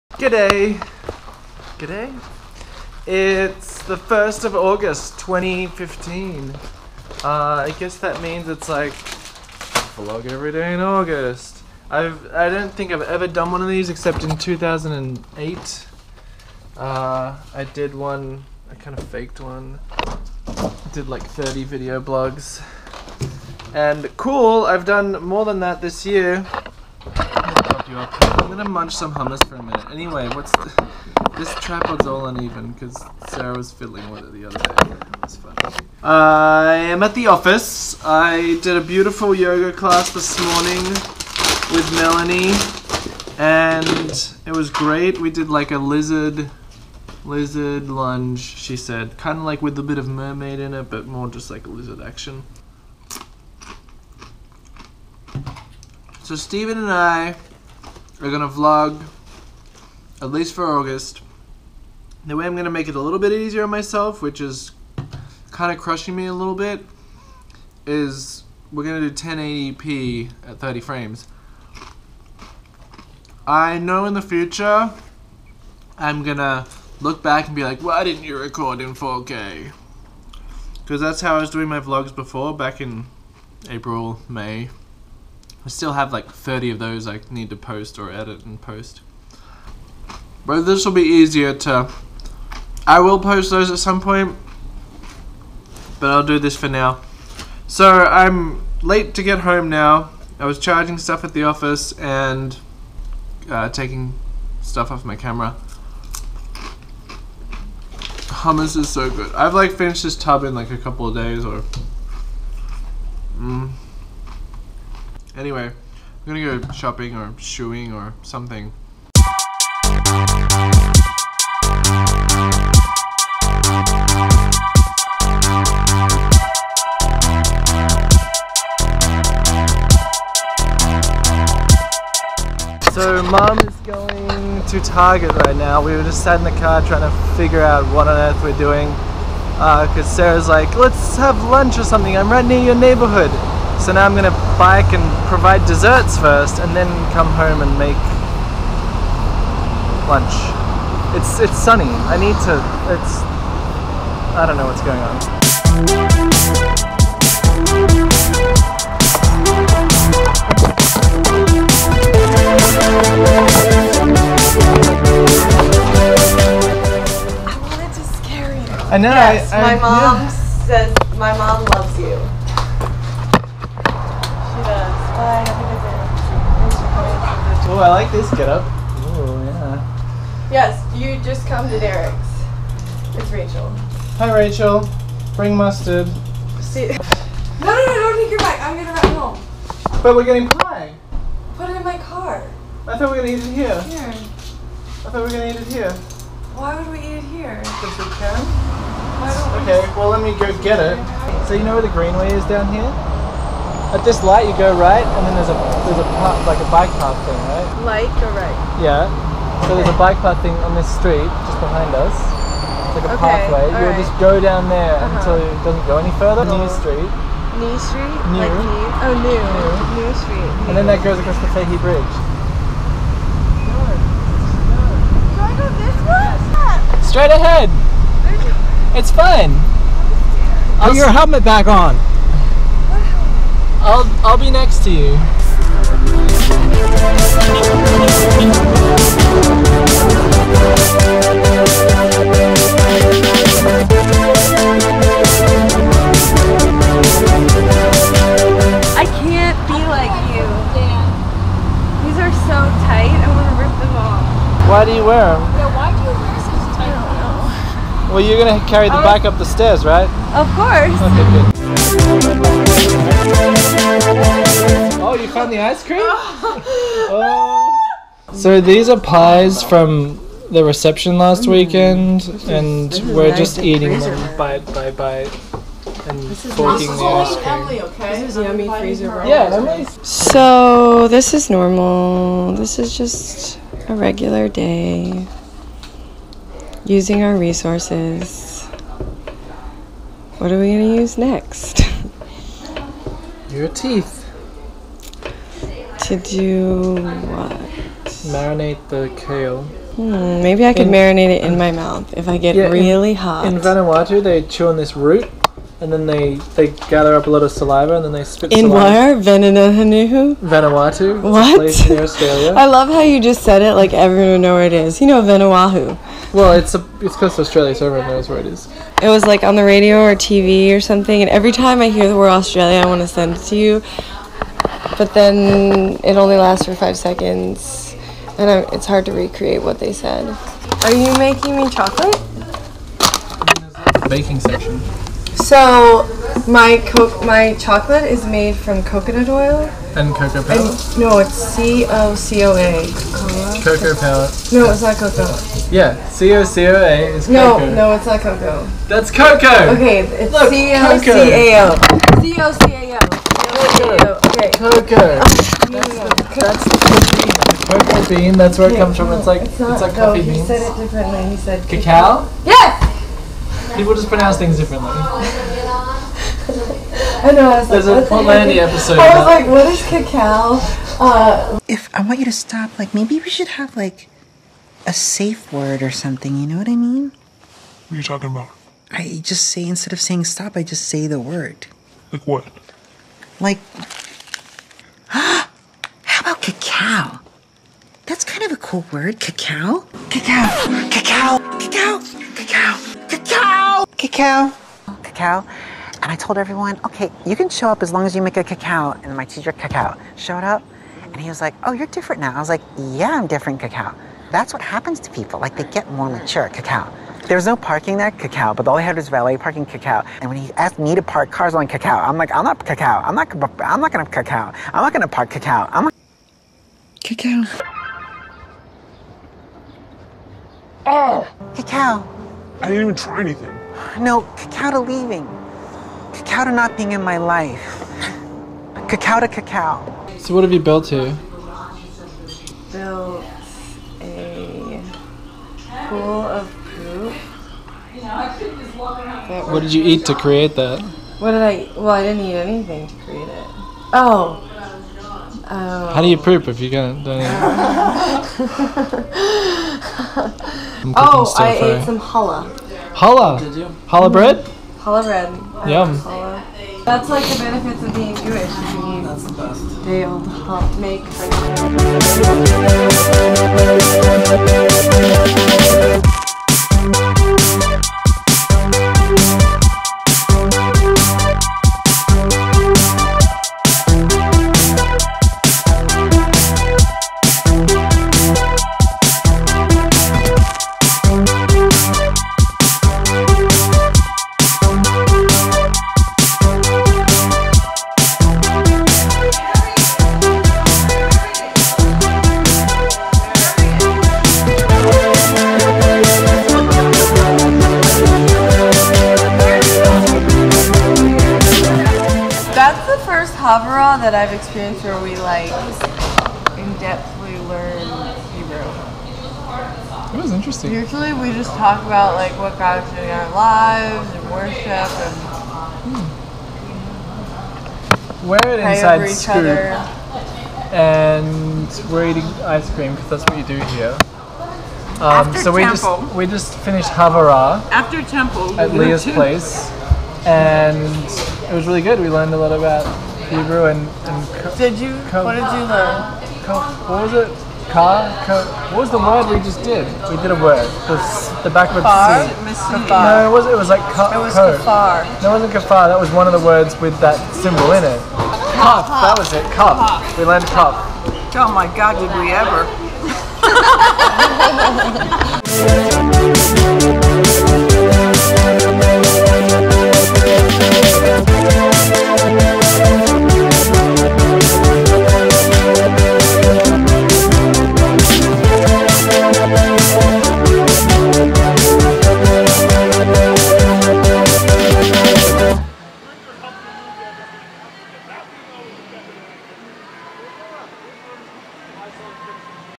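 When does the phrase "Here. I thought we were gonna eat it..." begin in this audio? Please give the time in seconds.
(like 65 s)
193 s.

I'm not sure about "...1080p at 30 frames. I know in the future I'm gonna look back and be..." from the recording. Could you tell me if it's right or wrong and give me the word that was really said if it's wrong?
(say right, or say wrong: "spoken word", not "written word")
right.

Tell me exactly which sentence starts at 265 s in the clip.
Oh, you found the ice cream?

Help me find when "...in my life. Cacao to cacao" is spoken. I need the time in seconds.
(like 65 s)
426 s.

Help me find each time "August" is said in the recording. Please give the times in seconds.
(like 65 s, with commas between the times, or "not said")
4 s, 10 s, 60 s.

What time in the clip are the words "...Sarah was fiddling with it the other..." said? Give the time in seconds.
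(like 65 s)
33 s.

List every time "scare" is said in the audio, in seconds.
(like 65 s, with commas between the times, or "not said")
168 s.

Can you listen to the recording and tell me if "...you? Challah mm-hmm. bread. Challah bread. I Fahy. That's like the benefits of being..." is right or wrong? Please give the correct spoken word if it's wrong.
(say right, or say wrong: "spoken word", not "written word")
wrong: "Yum", not "Fahy".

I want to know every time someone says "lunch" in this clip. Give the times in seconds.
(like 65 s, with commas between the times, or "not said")
141 s, 150 s.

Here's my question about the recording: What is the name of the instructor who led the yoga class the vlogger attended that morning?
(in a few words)
Melanie.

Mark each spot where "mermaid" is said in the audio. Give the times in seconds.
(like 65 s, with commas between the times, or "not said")
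50 s.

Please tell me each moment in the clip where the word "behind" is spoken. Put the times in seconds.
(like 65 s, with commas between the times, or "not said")
211 s.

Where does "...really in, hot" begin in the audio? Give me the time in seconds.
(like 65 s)
302 s.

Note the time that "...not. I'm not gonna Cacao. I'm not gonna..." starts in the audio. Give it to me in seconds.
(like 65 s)
413 s.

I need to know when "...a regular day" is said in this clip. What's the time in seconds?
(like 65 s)
283 s.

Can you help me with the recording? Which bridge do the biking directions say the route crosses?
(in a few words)
Fahy Bridge.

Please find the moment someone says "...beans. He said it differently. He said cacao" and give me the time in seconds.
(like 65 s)
360 s.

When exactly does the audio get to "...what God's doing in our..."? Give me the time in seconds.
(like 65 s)
512 s.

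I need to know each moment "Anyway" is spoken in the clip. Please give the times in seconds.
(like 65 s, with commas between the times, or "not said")
29 s, 115 s.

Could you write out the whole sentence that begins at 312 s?
I love how you just said it like everyone know where it is.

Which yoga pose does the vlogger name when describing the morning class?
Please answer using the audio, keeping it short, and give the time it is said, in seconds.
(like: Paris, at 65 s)
Lizard lunge, at 47 s.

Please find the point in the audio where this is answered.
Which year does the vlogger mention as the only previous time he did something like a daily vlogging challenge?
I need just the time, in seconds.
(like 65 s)
14 s.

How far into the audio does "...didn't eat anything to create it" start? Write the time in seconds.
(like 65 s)
442 s.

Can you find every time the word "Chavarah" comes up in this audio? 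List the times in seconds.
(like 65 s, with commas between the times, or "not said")
503 s, 526 s.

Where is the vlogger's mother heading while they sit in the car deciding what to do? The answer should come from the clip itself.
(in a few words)
Target.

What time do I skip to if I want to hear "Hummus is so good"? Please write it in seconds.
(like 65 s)
108 s.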